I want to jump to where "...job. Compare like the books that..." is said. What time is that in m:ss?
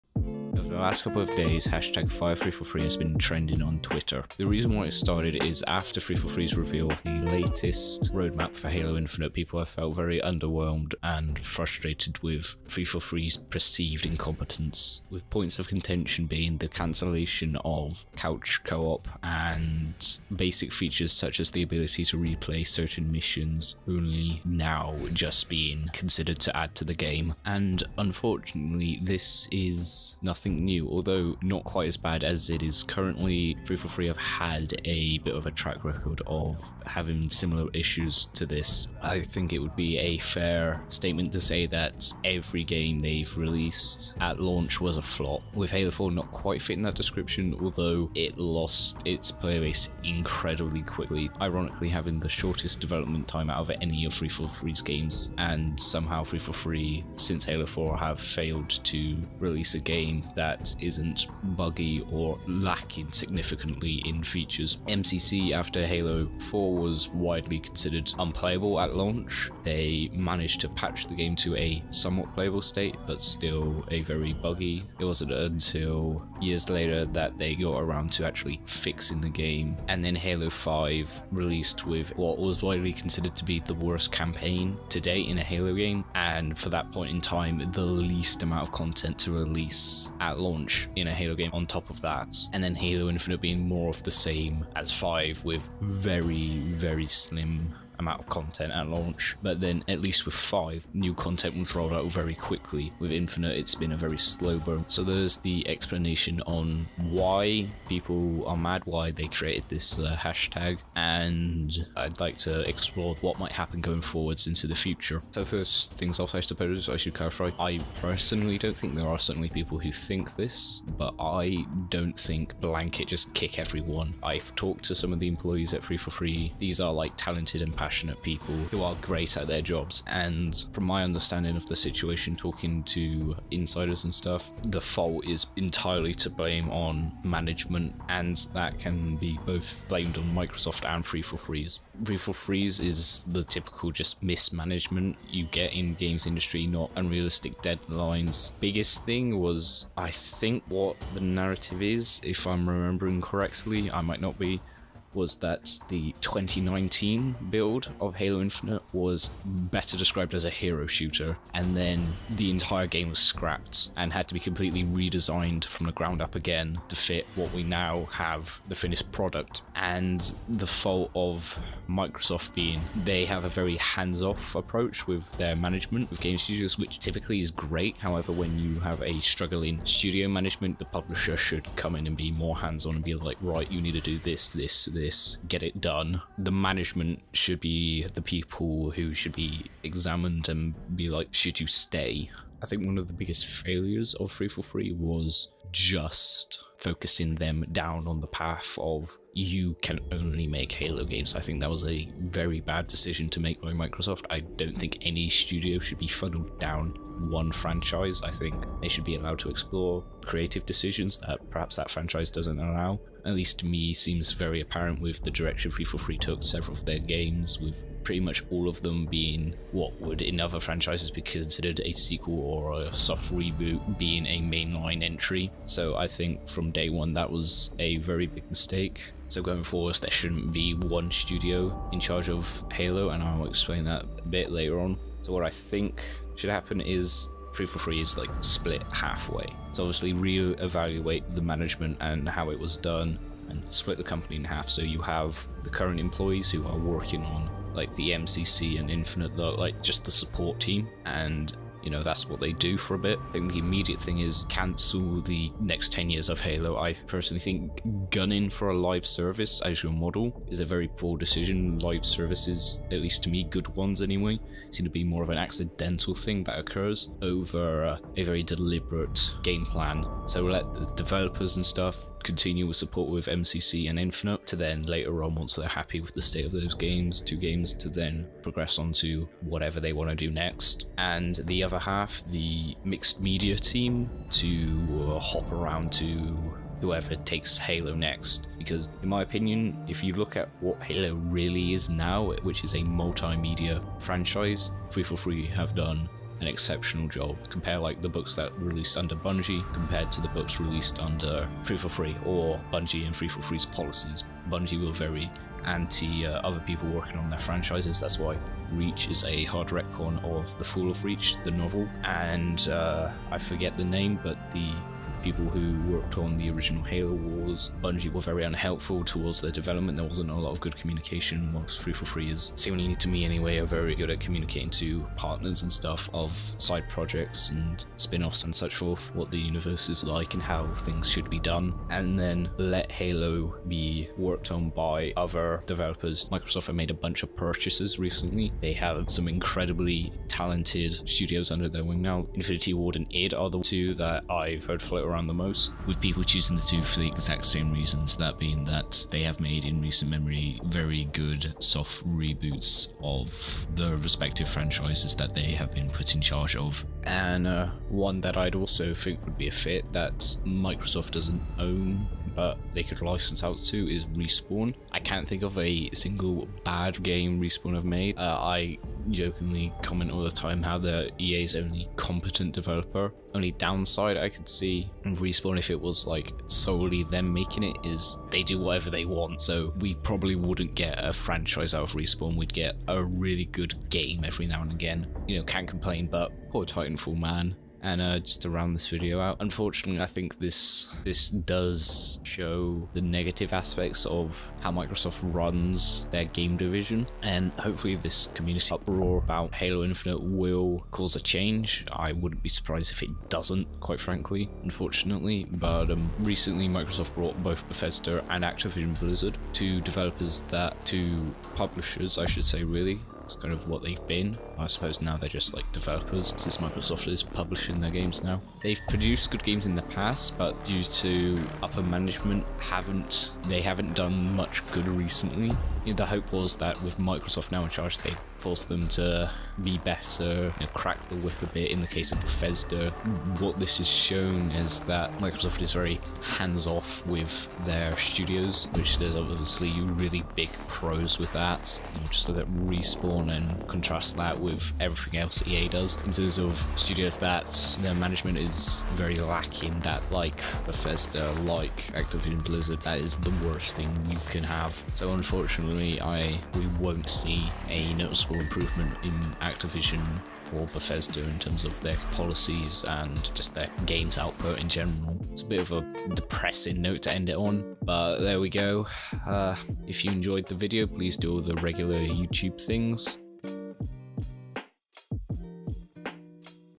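4:57.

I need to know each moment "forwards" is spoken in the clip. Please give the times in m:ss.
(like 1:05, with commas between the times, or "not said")
1:54, 3:49.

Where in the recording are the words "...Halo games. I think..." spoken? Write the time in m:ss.
3:20.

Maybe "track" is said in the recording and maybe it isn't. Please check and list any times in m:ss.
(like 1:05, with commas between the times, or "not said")
0:35.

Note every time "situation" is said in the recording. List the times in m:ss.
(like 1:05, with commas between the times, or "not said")
2:11.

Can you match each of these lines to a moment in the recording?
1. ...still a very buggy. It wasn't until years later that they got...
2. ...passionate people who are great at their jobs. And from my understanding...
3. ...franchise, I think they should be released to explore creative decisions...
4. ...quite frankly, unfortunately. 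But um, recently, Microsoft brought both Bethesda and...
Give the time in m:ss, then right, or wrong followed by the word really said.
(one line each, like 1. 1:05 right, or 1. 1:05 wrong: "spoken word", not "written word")
1. 1:13 right
2. 2:07 right
3. 3:27 wrong: "allowed", not "released"
4. 6:43 right.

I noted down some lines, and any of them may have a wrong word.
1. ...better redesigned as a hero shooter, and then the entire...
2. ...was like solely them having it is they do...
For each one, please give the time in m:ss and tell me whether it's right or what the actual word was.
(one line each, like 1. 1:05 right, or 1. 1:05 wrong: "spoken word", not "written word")
1. 2:39 wrong: "described", not "redesigned"
2. 6:15 wrong: "making", not "having".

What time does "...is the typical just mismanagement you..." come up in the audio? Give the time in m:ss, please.
2:22.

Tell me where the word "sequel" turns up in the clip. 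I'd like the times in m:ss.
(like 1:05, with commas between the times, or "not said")
3:41.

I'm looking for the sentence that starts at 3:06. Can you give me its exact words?
The management should be the people who should be examined and be like, should you stay?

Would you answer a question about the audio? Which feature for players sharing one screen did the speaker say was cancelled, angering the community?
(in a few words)
couch co-op.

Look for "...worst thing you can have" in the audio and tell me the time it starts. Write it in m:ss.
7:33.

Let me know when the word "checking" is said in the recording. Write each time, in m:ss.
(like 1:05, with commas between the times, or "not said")
not said.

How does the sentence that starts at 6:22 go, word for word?
We'd get a really good game every now and again.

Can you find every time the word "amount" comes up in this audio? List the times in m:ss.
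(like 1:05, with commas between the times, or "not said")
1:28, 1:38.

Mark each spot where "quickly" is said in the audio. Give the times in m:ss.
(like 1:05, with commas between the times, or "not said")
0:50, 1:42.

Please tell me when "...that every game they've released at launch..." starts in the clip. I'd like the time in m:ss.
0:41.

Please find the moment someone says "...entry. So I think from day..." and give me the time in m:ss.
3:45.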